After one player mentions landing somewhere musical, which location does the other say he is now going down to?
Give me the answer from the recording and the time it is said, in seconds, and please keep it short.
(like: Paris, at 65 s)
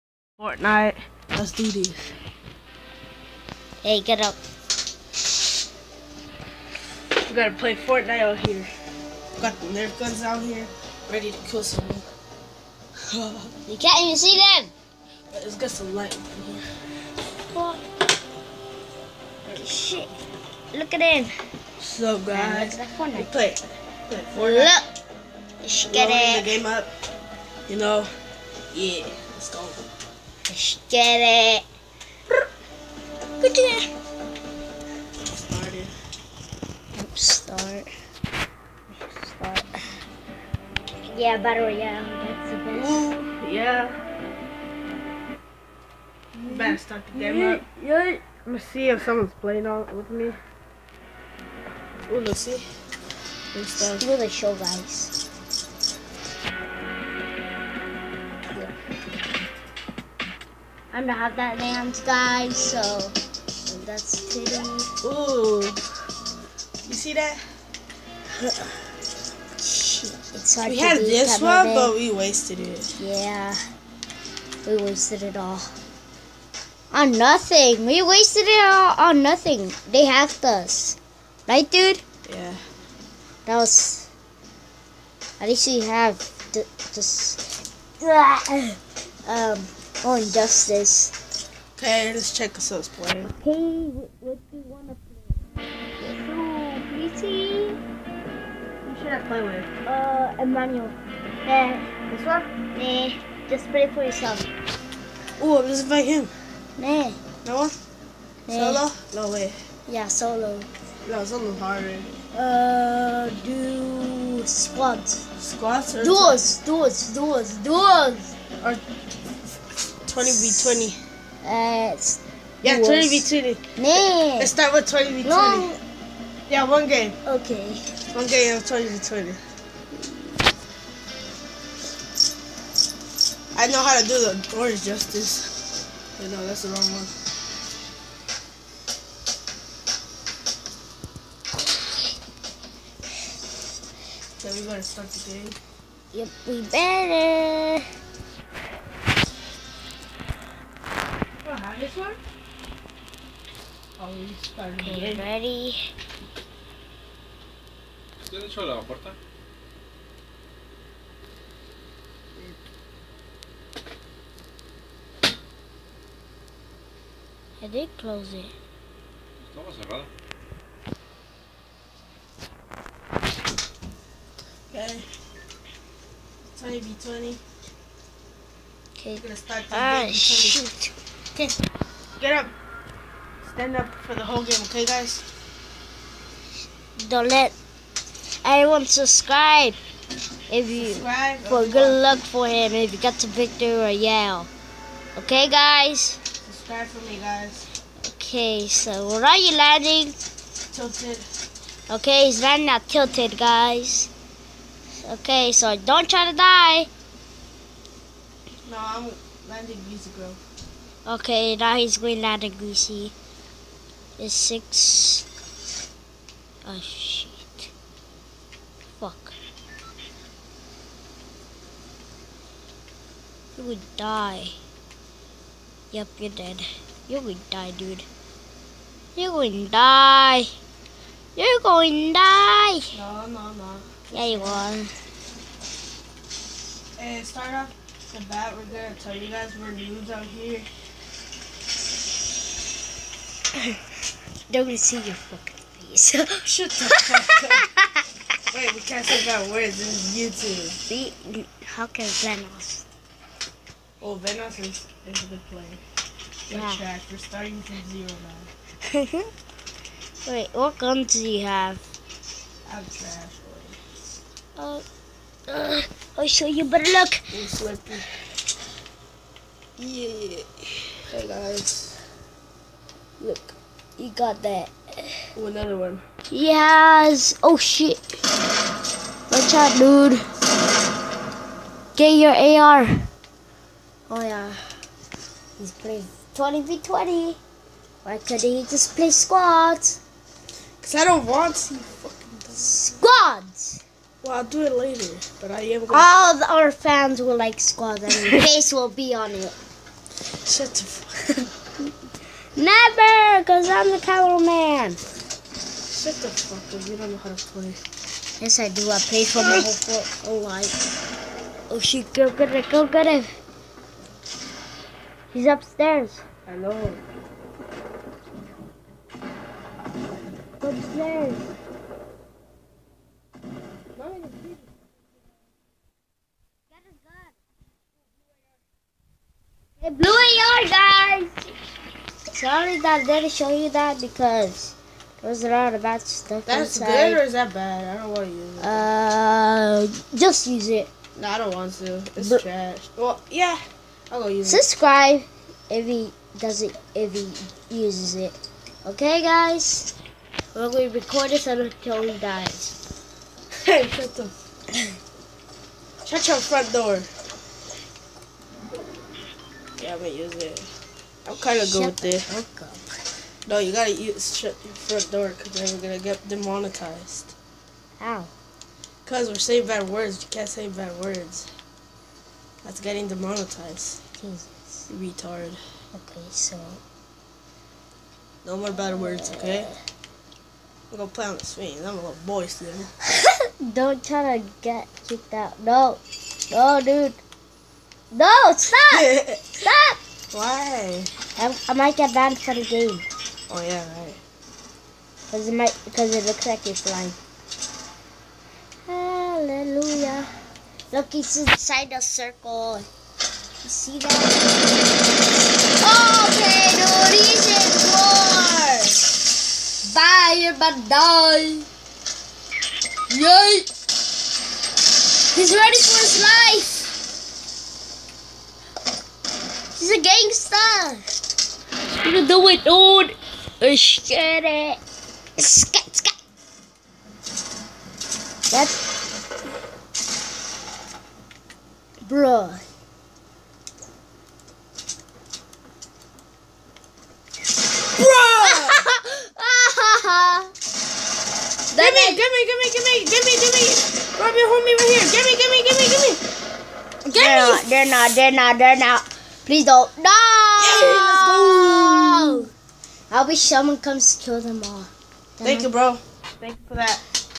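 Greasy, at 212 s.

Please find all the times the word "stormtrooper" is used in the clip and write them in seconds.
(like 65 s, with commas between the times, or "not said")
not said.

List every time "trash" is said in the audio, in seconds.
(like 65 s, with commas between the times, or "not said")
262 s, 342 s.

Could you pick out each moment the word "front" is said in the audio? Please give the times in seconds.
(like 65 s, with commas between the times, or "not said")
356 s, 364 s.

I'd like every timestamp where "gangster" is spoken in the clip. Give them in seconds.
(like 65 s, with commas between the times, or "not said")
420 s.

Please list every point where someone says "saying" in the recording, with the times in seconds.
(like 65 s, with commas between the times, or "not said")
369 s.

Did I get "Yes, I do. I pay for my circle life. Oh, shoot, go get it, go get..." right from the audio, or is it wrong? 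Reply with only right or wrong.
wrong.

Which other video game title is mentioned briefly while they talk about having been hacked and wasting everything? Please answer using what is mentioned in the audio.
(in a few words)
Injustice.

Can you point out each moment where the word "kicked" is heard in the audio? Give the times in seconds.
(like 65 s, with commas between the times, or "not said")
385 s.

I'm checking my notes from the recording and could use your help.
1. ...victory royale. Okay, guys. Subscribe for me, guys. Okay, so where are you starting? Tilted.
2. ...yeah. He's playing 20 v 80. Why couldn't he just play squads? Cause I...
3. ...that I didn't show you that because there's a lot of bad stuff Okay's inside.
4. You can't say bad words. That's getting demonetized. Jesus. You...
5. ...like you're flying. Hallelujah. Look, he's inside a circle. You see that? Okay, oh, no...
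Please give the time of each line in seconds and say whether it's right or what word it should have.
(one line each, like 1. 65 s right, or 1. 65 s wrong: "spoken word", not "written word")
1. 193 s wrong: "landing", not "starting"
2. 284 s wrong: "20", not "80"
3. 332 s wrong: "That", not "Okay"
4. 370 s right
5. 396 s right.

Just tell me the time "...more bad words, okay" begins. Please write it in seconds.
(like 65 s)
378 s.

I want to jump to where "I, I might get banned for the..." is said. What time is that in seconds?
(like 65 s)
391 s.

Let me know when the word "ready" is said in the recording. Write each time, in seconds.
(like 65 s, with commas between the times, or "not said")
11 s, 155 s, 415 s.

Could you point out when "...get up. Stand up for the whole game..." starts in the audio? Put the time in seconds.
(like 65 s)
182 s.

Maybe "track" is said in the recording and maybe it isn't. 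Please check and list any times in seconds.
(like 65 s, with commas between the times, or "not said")
256 s.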